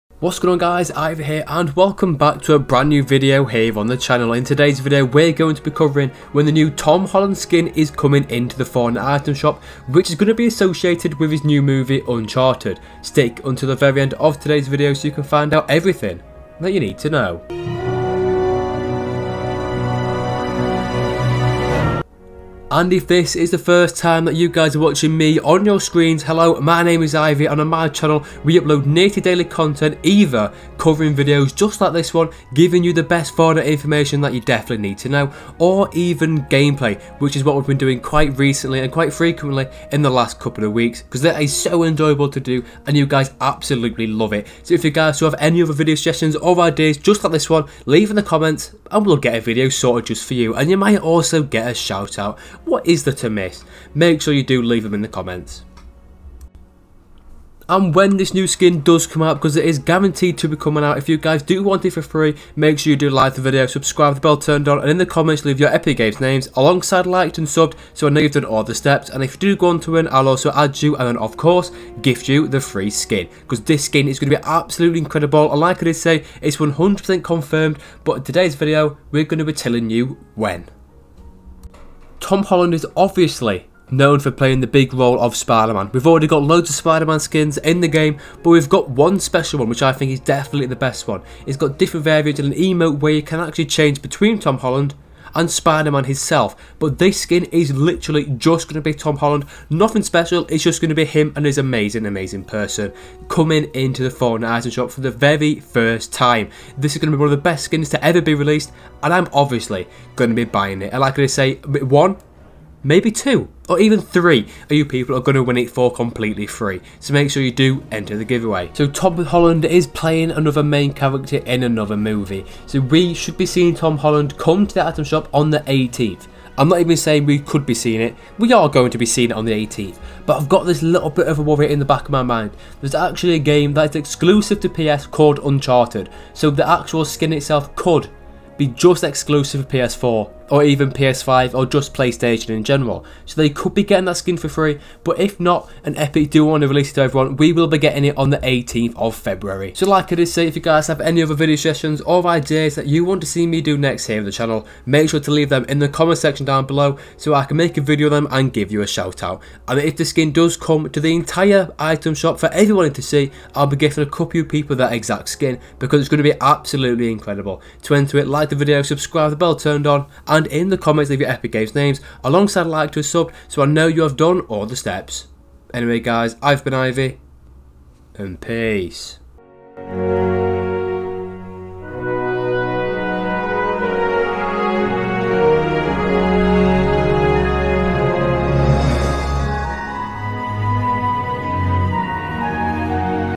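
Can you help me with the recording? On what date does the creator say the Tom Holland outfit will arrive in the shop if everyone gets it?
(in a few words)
18th of February.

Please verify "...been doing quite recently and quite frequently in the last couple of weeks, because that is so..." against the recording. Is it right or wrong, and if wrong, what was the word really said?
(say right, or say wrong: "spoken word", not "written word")
right.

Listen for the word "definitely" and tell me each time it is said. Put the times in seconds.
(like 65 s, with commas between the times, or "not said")
34 s, 90 s.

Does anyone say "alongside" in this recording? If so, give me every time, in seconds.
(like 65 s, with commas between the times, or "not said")
66 s, 172 s.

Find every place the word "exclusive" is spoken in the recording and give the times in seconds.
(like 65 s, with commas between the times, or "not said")
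133 s, 139 s.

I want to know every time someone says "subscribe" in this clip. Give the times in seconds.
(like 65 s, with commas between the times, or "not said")
63 s, 168 s.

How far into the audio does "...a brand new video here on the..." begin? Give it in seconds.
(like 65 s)
2 s.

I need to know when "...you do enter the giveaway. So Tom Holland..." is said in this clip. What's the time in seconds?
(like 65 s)
117 s.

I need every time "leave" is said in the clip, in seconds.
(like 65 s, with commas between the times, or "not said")
47 s, 54 s, 65 s, 155 s, 171 s.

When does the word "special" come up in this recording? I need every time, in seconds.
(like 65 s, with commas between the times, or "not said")
89 s, 100 s.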